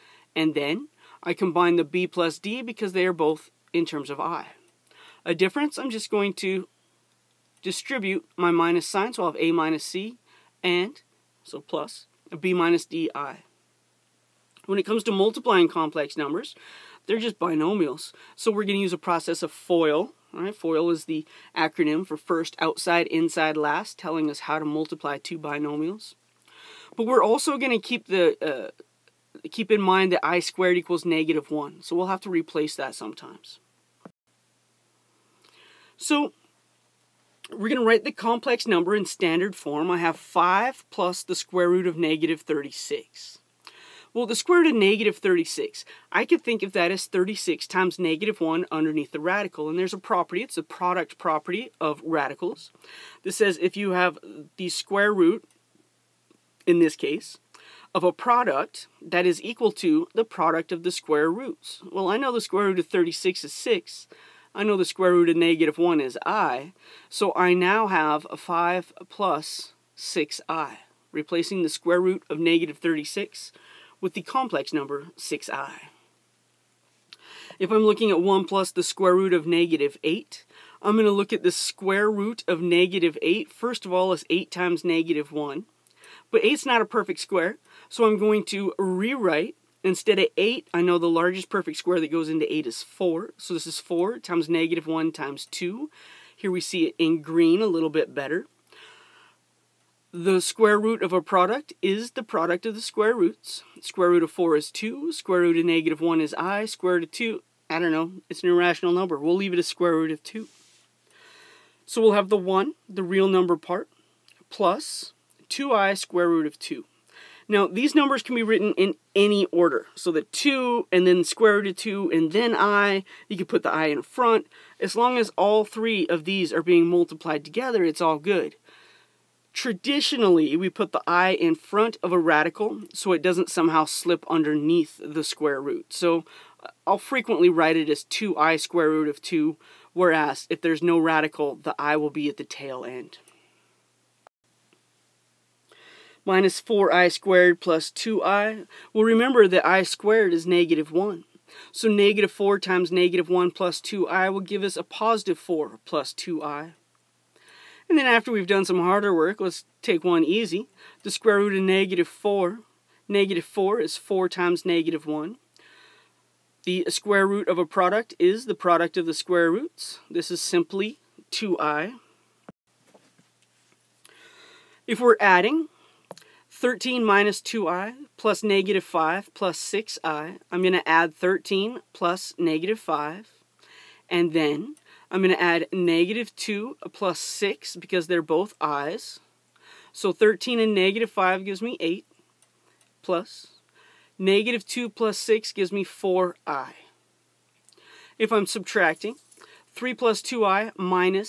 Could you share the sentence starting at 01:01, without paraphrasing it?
Well, I know the square root of 36 is 6.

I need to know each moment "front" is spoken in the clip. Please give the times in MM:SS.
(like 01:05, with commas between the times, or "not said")
02:04, 02:11.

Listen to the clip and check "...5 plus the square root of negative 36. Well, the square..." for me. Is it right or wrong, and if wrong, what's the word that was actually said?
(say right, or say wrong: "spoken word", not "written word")
right.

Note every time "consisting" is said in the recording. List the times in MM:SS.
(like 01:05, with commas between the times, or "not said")
not said.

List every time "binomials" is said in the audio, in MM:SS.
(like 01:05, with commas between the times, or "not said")
00:17, 00:25.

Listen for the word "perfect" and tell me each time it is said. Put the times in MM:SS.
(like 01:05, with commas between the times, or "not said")
01:26, 01:31.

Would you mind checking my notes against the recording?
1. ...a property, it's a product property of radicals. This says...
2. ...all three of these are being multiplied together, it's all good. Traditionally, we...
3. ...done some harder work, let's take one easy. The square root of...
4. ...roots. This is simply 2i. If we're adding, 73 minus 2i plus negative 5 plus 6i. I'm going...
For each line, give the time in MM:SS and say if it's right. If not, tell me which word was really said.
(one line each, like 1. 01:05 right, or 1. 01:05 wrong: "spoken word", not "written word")
1. 00:49 right
2. 02:05 right
3. 02:38 right
4. 02:49 wrong: "13", not "73".